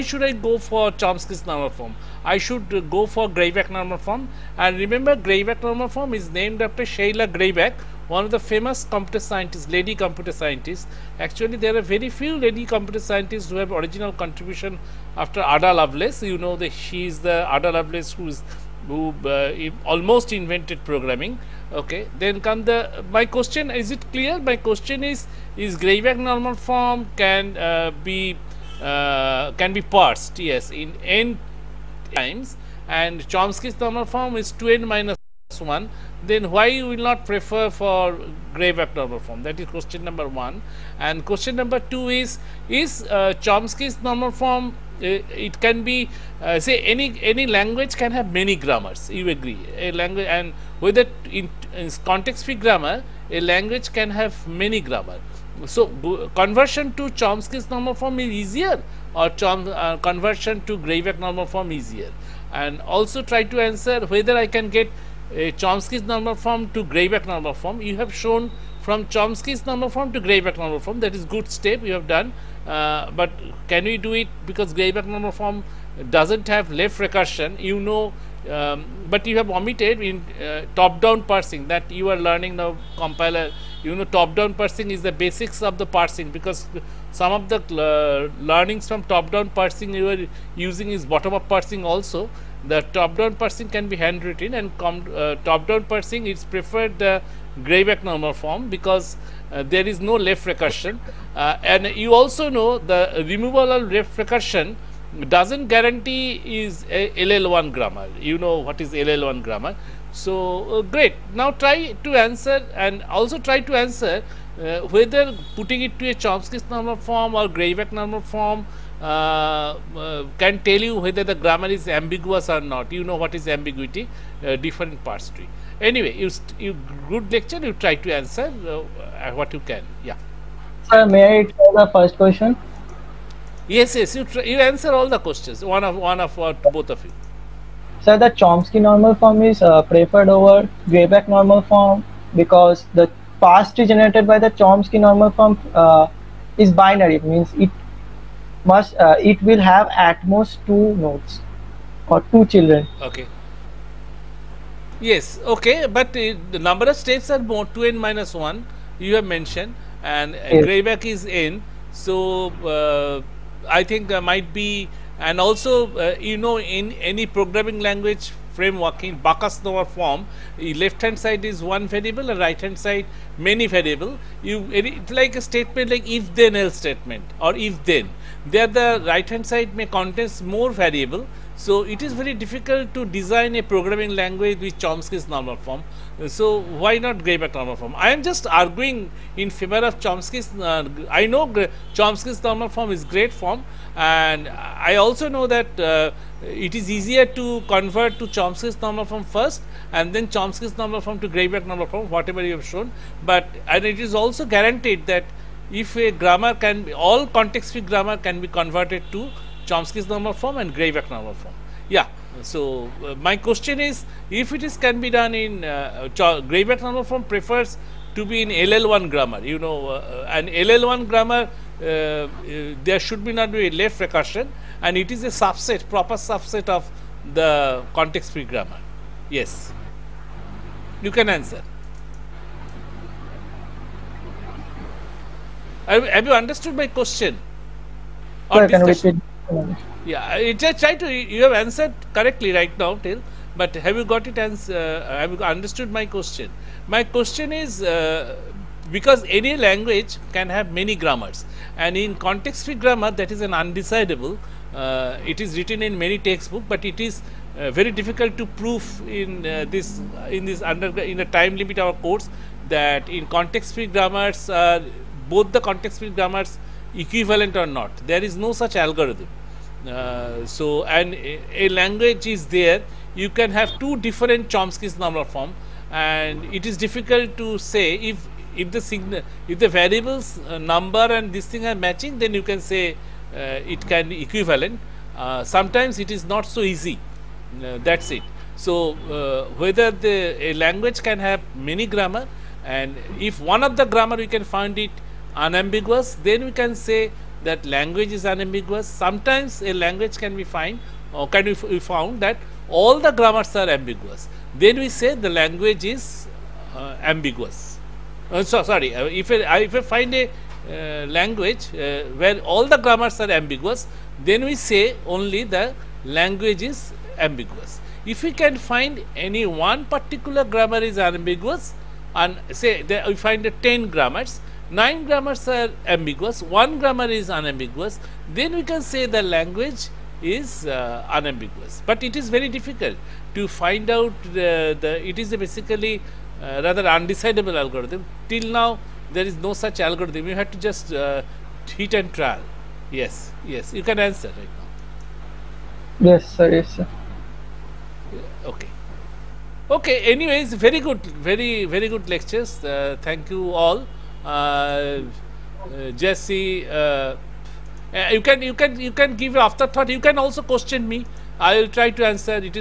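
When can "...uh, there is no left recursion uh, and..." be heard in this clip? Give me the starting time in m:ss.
1:39.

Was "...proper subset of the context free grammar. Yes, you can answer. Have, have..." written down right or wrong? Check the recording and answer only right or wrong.
right.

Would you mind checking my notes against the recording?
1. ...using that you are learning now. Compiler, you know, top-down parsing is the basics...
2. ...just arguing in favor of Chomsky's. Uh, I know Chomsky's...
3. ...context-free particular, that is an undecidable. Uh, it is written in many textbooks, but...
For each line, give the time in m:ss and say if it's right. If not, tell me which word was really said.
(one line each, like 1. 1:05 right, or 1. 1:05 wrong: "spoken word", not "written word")
1. 1:21 wrong: "parsing", not "using"
2. 3:08 right
3. 4:12 wrong: "grammar", not "particular".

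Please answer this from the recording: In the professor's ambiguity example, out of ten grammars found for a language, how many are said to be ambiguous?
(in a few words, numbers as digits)
9.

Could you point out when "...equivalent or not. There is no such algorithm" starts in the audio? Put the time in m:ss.
4:26.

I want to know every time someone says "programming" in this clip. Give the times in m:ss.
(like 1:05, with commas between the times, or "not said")
0:20, 2:47, 3:03.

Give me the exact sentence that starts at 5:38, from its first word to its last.
Till now there is no such algorithm, you have to just uh, hit and trial.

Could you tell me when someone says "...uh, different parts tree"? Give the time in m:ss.
2:04.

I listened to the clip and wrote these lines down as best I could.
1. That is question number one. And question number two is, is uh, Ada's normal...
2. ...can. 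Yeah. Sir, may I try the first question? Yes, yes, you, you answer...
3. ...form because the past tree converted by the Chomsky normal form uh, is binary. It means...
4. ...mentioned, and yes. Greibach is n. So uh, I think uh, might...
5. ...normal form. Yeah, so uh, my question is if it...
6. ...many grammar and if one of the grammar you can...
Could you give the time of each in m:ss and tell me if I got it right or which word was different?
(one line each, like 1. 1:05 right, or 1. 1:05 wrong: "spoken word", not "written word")
1. 0:39 wrong: "Chomsky", not "Ada"
2. 2:09 right
3. 2:21 wrong: "generated", not "converted"
4. 2:39 right
5. 3:31 right
6. 4:51 right.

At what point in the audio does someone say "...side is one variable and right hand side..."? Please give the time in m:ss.
2:51.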